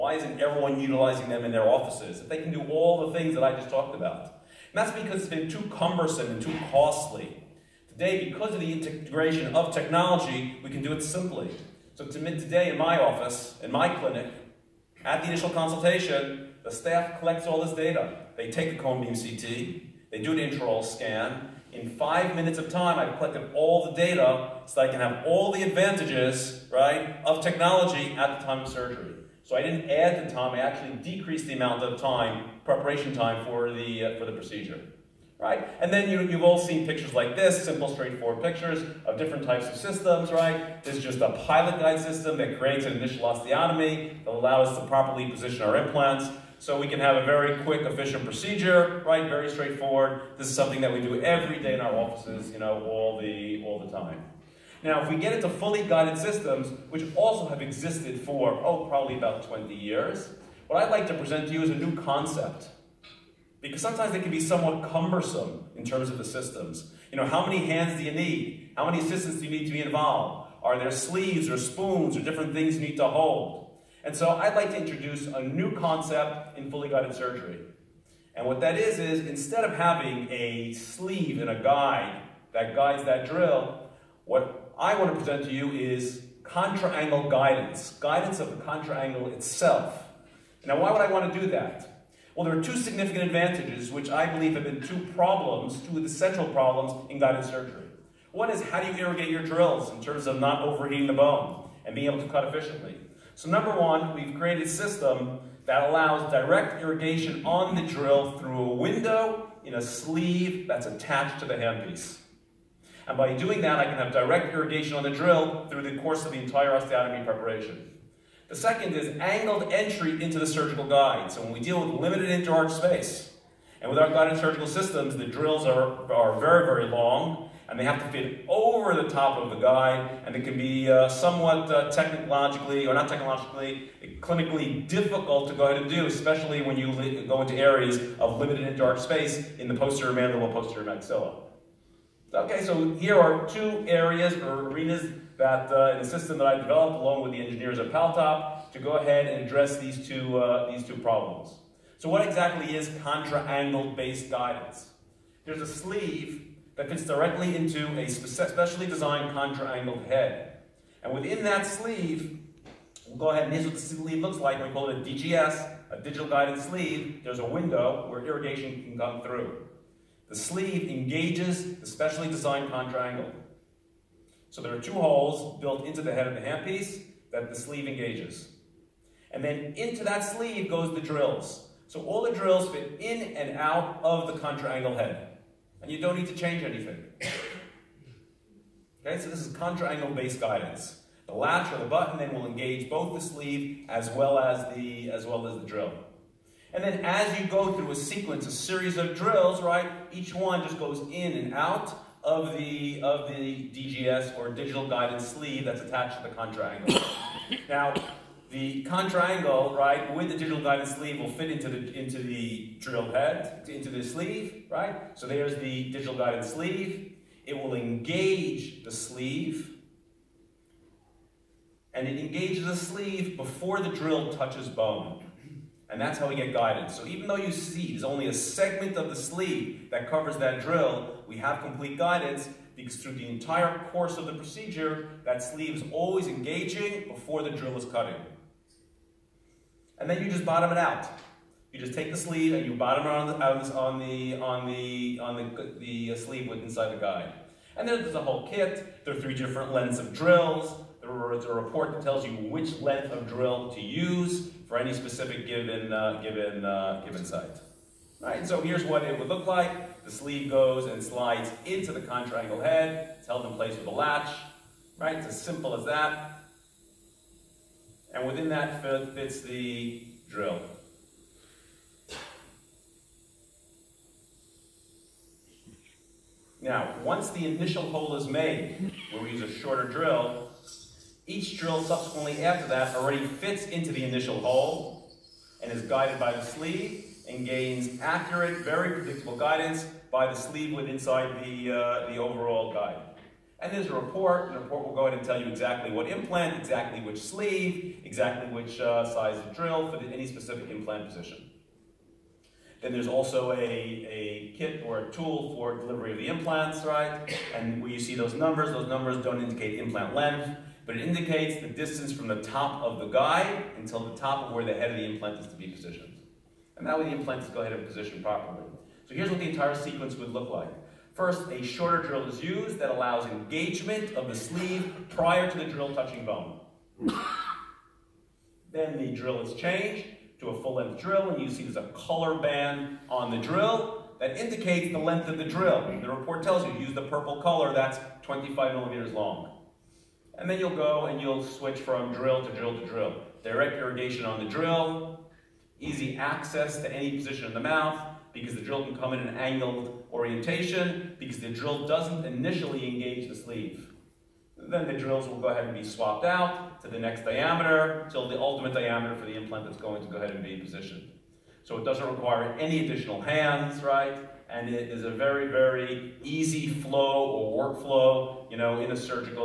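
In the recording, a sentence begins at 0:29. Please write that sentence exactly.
So I didn't add the time, I actually decreased the amount of time, preparation time for the, uh, for the procedure right?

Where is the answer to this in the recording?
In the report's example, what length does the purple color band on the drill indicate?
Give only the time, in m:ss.
5:38.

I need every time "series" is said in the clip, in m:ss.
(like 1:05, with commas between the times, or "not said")
3:18.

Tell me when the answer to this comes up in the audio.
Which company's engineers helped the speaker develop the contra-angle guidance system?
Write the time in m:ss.
2:27.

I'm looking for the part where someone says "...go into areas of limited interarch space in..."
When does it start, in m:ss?
2:17.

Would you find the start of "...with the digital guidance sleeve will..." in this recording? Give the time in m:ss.
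3:30.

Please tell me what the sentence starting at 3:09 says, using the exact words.
okay, so this is contra-angle based guidance.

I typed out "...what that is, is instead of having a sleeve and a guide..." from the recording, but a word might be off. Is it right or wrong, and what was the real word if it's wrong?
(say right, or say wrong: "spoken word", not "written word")
right.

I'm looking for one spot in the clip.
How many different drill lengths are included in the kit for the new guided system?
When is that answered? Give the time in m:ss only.
4:09.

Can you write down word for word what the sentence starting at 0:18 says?
They take a cone beam CT, they do an intraoral scan.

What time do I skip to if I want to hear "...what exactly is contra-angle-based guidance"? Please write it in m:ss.
2:32.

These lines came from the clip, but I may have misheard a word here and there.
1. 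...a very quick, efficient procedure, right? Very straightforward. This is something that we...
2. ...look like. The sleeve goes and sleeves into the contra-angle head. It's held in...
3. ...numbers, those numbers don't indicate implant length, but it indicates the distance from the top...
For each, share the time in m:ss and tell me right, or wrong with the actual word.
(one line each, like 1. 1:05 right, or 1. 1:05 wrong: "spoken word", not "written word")
1. 0:47 right
2. 4:19 wrong: "slides", not "sleeves"
3. 5:08 right.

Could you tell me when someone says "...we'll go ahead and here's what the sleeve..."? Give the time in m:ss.
2:43.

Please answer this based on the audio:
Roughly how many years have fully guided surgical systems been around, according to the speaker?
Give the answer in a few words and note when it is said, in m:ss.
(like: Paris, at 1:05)
20 years, at 0:59.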